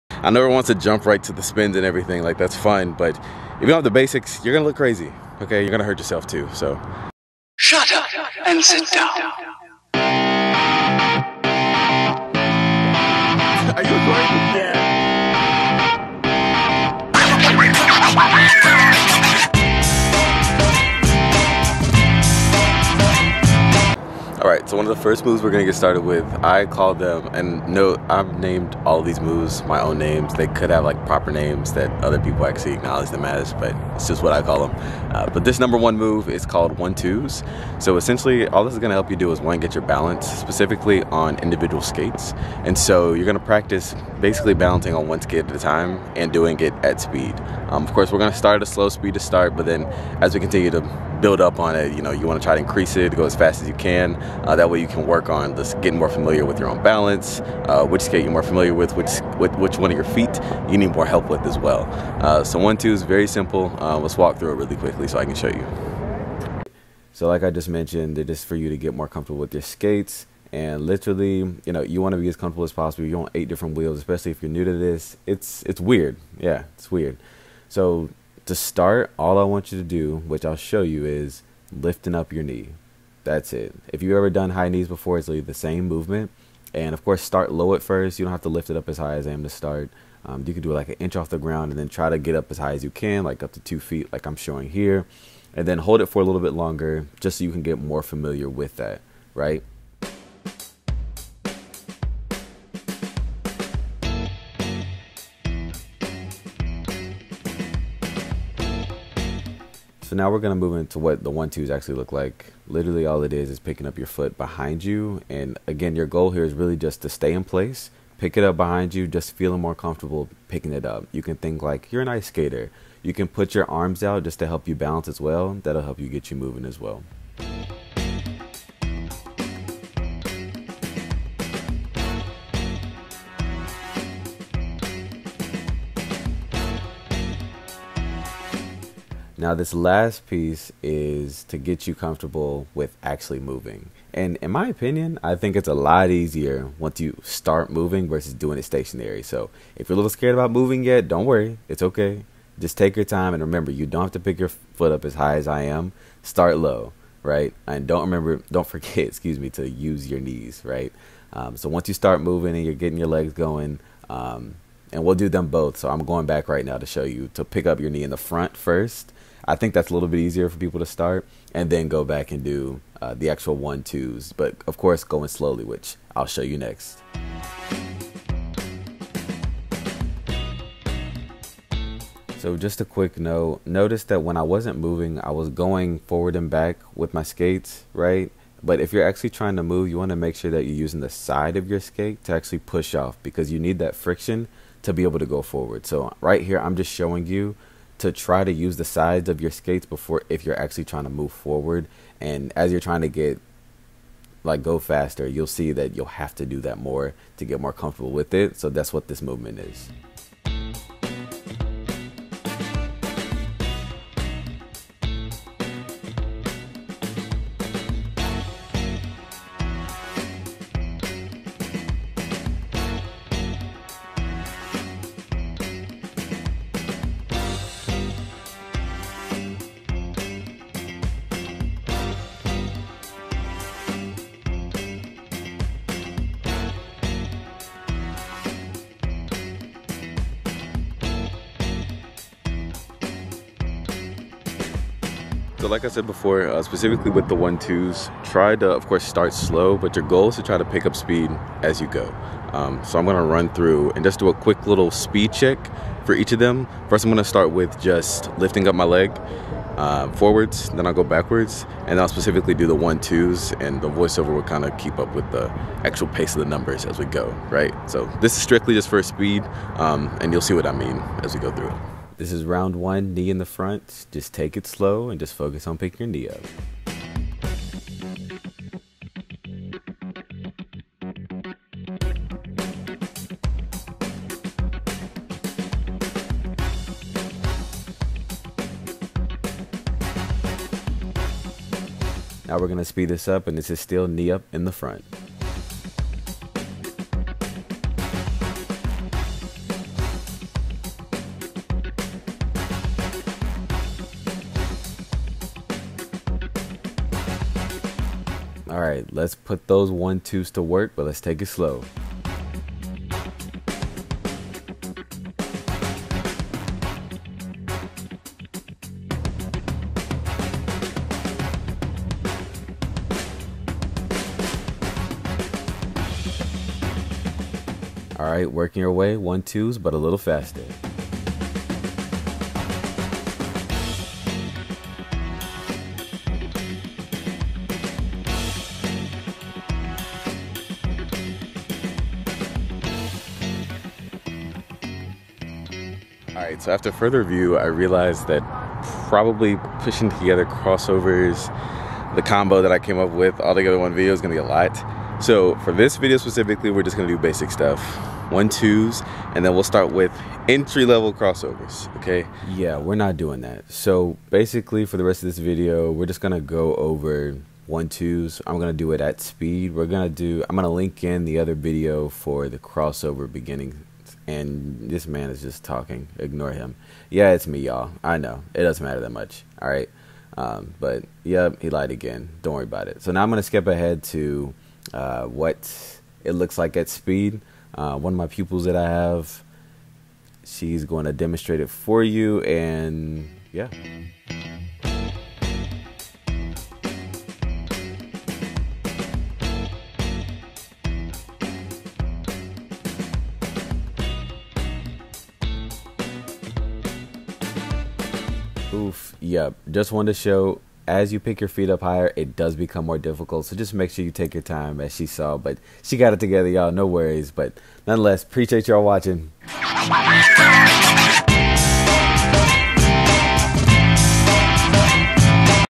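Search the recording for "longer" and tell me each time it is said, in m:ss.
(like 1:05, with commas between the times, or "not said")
1:36.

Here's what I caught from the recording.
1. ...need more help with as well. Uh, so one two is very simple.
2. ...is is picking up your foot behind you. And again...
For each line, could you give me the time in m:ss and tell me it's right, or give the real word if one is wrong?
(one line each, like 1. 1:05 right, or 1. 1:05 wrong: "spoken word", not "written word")
1. 1:00 right
2. 1:53 right.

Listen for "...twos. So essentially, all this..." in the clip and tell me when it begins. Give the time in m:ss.
0:36.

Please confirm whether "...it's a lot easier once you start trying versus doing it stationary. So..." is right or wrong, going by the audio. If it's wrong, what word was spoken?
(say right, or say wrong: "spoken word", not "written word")
wrong: "moving", not "trying".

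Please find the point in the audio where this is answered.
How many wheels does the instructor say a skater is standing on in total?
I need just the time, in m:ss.
1:13.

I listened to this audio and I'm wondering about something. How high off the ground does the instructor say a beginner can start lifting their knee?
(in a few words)
an inch.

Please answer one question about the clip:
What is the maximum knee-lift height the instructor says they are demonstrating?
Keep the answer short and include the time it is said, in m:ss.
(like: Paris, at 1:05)
2 feet, at 1:33.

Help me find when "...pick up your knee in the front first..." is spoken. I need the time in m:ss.
2:47.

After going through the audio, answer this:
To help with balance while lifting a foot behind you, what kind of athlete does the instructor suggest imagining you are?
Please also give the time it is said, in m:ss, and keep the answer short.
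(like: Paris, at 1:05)
an ice skater, at 2:02.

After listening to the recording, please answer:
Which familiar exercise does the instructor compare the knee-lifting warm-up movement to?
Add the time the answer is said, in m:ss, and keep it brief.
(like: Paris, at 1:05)
high knees, at 1:24.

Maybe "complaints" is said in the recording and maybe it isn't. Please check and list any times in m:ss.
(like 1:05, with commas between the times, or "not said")
not said.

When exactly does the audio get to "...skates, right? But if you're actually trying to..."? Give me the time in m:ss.
3:07.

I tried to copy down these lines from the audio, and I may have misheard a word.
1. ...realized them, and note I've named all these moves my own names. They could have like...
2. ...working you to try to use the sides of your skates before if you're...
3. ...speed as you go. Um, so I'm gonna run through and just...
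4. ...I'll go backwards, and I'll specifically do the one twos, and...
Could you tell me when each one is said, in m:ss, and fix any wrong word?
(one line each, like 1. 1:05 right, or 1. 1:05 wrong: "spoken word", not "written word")
1. 0:26 wrong: "called", not "realized"
2. 3:16 wrong: "showing", not "working"
3. 4:10 right
4. 4:20 right.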